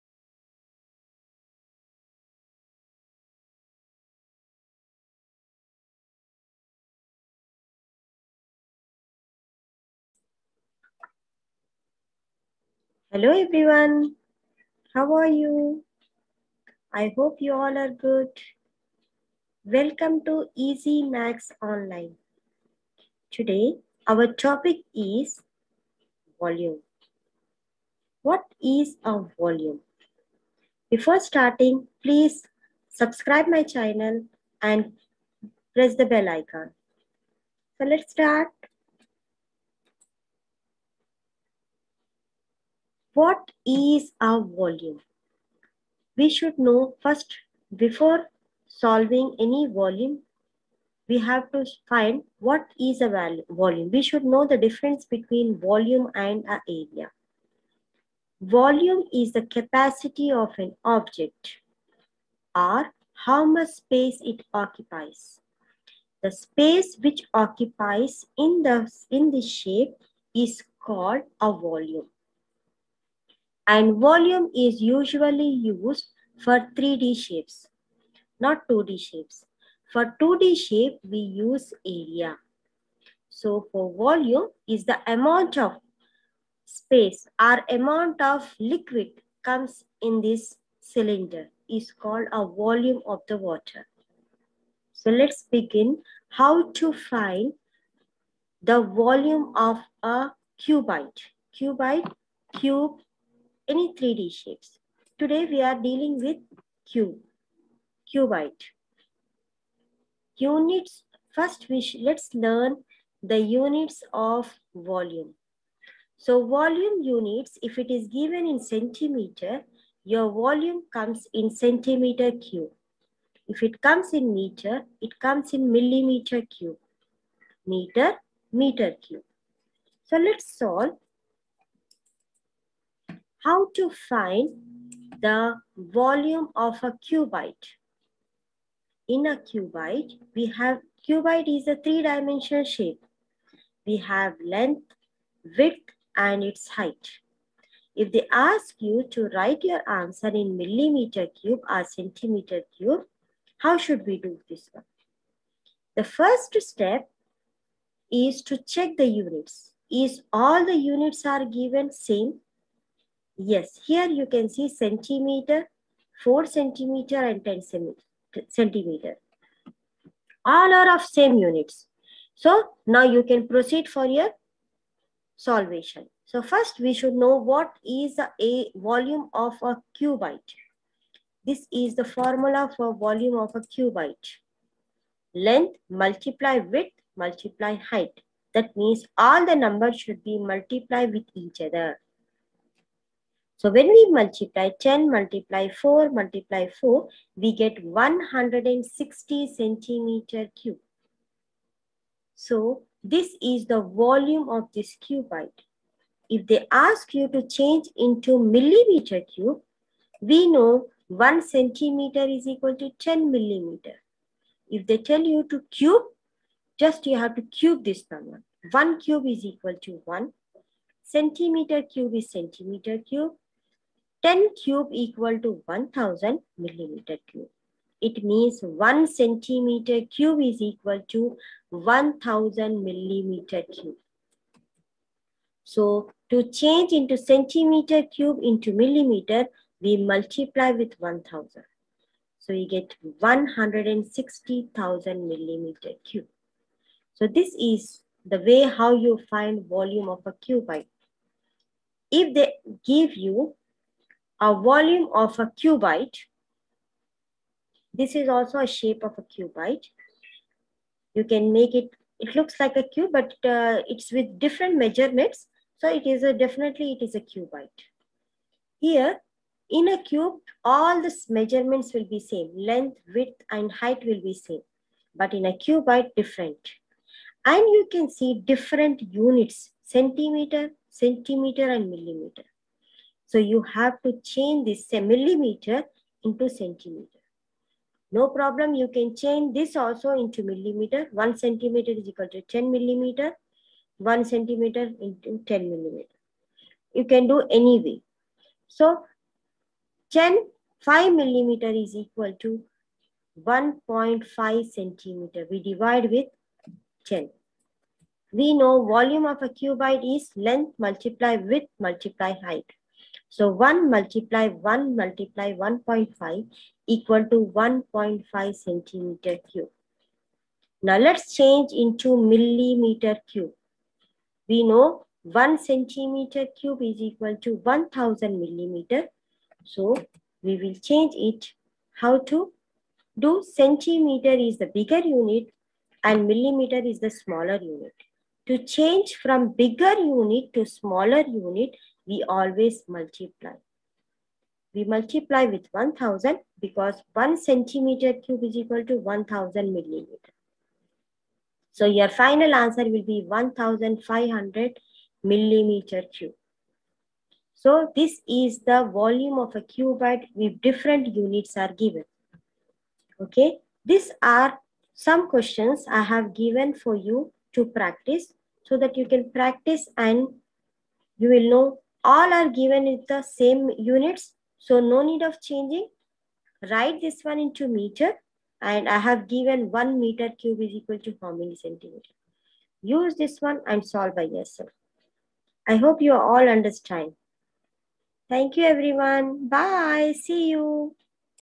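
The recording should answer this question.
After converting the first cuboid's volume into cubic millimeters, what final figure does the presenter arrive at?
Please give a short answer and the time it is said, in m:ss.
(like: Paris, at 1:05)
160,000 mm³, at 4:03.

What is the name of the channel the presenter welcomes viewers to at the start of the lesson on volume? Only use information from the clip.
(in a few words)
Easy Maths Online.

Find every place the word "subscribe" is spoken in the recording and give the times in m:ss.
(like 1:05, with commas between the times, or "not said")
0:32.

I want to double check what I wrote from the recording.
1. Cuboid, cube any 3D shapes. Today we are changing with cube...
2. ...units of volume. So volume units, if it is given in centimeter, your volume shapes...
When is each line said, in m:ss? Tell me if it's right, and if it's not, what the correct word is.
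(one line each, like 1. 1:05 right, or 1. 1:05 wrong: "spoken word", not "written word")
1. 1:41 wrong: "dealing", not "changing"
2. 1:53 wrong: "comes", not "shapes".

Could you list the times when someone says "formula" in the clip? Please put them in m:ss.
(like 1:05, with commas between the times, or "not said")
3:02.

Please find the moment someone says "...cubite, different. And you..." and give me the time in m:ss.
4:35.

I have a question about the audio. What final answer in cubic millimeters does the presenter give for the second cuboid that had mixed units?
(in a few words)
1500 mm³.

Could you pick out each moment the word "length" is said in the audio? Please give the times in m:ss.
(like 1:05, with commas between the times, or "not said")
2:24, 3:05, 4:32, 5:10.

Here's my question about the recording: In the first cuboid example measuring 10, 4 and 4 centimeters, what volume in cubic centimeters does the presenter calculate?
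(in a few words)
160 cm³.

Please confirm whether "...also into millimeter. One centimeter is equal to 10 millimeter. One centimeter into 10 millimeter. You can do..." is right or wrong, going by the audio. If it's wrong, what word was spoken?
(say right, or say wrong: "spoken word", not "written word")
right.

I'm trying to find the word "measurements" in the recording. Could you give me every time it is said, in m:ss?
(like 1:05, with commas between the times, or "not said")
4:24, 4:31.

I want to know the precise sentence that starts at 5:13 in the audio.
So 1 multiply 1 multiply 1.5 equal to 1.5 centimeter cube.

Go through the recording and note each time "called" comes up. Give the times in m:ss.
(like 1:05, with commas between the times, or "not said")
1:10, 1:31.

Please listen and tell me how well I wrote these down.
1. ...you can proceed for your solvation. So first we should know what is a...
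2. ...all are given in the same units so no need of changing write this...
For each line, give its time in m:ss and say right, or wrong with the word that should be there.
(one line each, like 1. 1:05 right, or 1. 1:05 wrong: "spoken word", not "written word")
1. 2:53 right
2. 6:12 right.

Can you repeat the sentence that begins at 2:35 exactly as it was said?
The first step is to check the units.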